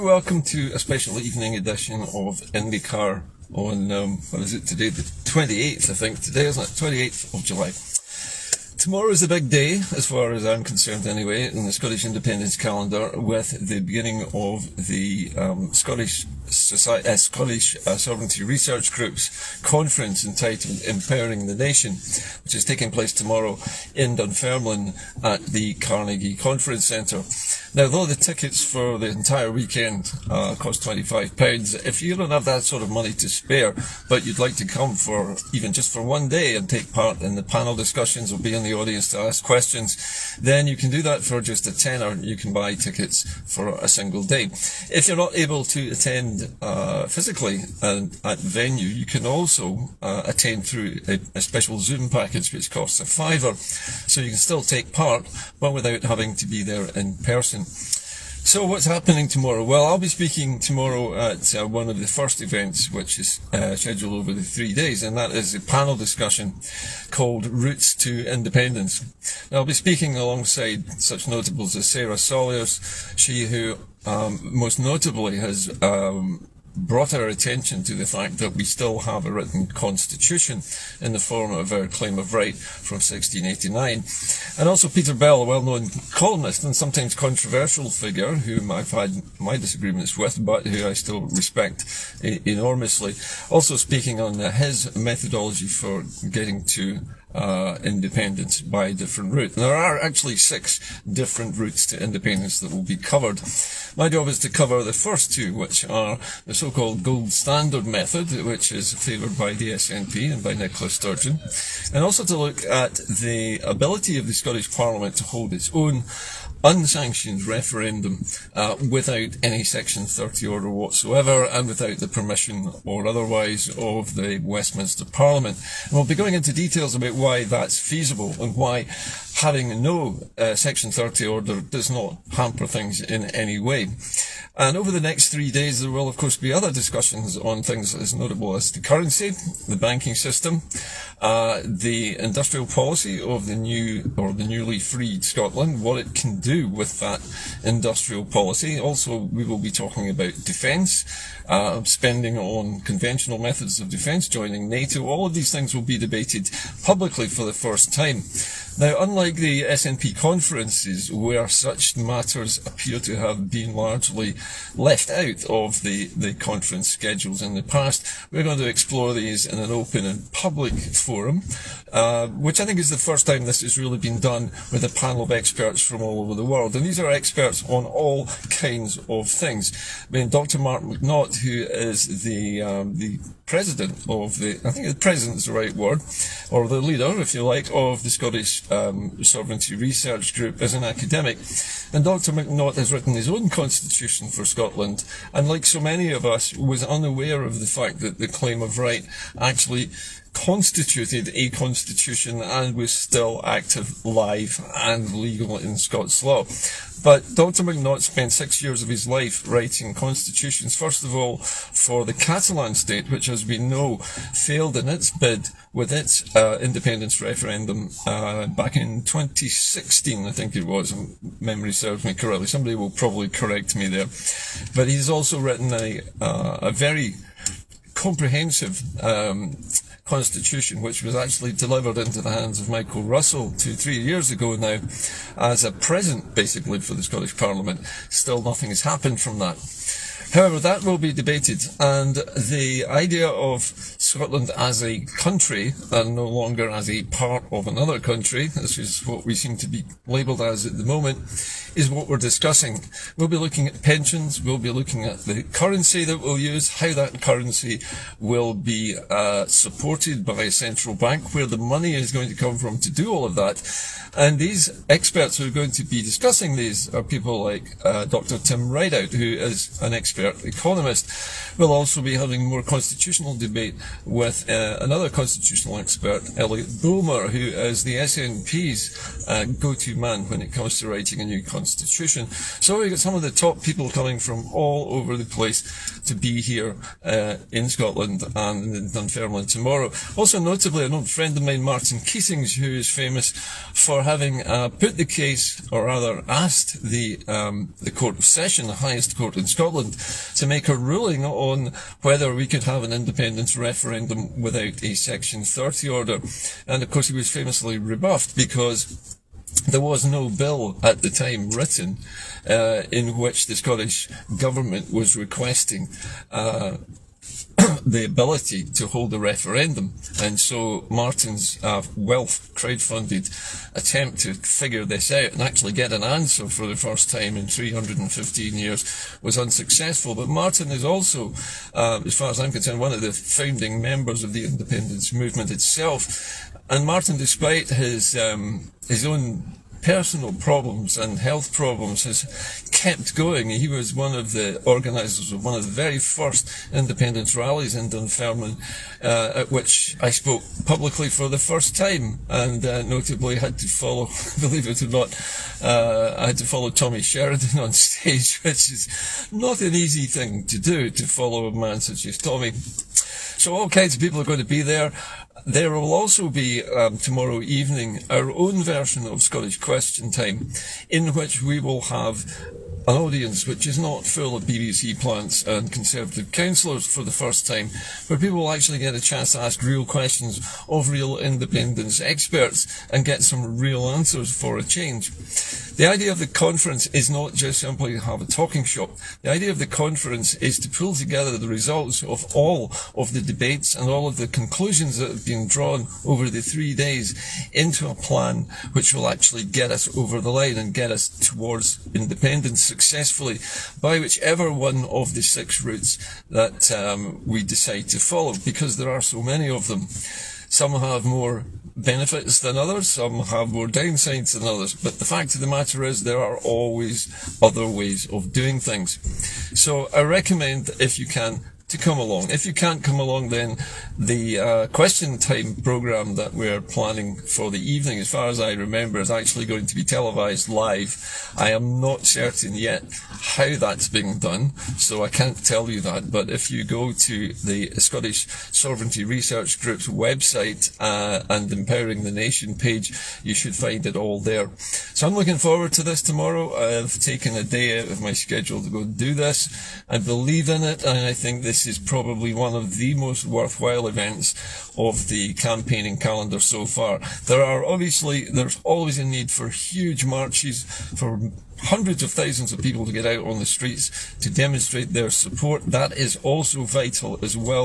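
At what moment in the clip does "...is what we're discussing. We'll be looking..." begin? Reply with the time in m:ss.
4:11.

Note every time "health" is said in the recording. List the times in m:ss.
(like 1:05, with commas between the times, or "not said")
5:41.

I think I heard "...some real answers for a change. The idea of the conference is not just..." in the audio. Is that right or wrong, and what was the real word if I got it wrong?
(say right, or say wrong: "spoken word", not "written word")
right.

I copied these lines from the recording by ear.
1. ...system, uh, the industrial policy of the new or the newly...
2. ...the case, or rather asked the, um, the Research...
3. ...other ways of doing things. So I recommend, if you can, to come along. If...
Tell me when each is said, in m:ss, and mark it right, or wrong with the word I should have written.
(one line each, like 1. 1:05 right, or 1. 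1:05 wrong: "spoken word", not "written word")
1. 2:20 right
2. 4:54 wrong: "Court", not "Research"
3. 6:57 right.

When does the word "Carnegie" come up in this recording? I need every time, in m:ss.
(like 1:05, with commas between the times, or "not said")
0:25.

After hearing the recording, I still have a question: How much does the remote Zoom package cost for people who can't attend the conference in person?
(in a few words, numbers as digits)
£5.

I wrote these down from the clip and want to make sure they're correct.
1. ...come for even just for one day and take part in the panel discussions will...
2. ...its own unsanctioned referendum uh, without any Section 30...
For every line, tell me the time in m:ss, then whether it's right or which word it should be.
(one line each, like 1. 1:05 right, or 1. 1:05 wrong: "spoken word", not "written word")
1. 0:34 right
2. 1:55 right.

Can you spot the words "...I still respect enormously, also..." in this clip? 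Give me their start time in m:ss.
1:30.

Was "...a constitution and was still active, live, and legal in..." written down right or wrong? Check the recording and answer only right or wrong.
right.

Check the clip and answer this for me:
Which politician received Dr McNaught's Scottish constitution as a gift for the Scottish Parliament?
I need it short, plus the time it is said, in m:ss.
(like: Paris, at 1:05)
Michael Russell, at 3:52.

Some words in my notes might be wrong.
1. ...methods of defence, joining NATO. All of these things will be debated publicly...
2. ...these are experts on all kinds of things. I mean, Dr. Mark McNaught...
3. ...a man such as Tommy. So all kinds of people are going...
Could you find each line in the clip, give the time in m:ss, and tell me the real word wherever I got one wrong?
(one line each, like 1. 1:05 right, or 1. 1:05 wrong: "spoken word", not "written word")
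1. 2:33 right
2. 2:56 right
3. 6:01 right.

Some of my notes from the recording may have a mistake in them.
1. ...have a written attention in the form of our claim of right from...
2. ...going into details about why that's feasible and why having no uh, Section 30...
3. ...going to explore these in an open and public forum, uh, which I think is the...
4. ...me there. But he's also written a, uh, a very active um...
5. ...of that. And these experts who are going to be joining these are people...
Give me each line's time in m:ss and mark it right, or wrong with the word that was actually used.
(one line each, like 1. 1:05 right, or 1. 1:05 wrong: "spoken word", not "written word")
1. 1:18 wrong: "constitution", not "attention"
2. 2:06 right
3. 2:48 right
4. 3:43 wrong: "comprehensive", not "active"
5. 4:23 wrong: "discussing", not "joining".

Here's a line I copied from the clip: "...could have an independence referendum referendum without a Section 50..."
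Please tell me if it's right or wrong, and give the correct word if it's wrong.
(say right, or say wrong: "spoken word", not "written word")
wrong: "30", not "50".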